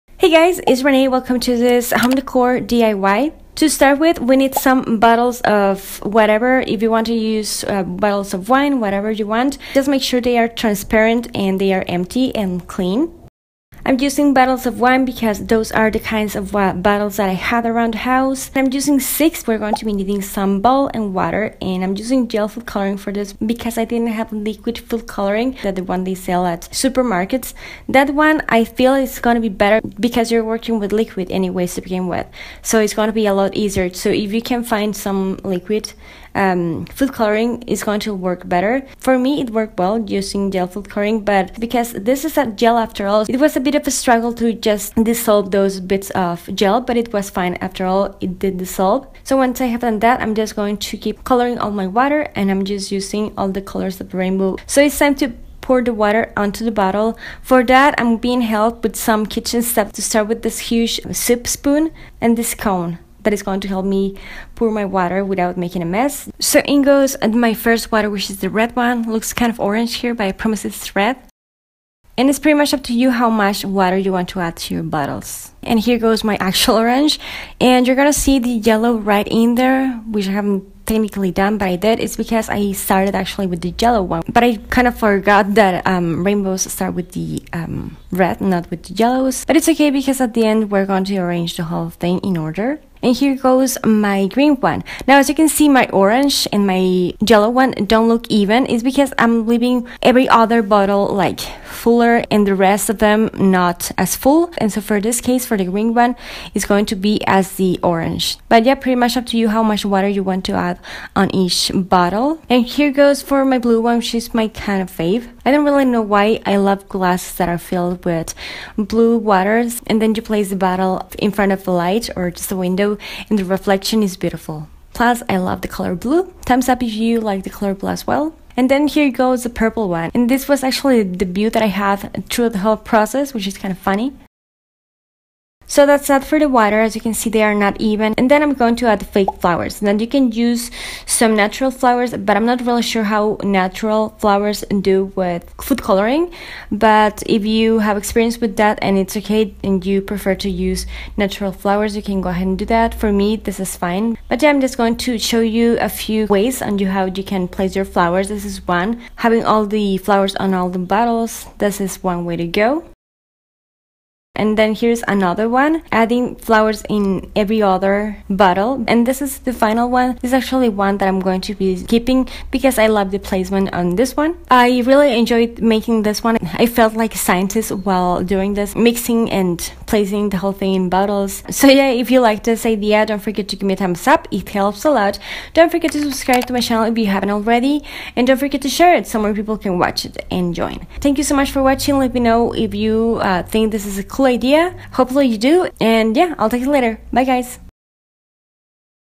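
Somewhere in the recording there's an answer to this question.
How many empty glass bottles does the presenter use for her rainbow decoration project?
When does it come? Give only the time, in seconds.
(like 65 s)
18 s.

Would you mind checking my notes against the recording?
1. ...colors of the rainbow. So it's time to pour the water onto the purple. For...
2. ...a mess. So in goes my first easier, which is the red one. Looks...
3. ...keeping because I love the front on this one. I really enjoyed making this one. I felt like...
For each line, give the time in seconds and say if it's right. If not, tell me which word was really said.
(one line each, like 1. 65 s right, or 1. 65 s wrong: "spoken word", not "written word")
1. 53 s wrong: "bottle", not "purple"
2. 65 s wrong: "water", not "easier"
3. 171 s wrong: "placement", not "front".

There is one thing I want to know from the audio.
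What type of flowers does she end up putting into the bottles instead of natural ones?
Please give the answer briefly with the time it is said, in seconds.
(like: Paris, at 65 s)
fake flowers, at 139 s.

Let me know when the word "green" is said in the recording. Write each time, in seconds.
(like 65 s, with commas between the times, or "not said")
94 s, 105 s.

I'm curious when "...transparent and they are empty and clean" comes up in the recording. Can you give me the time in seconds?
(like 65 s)
10 s.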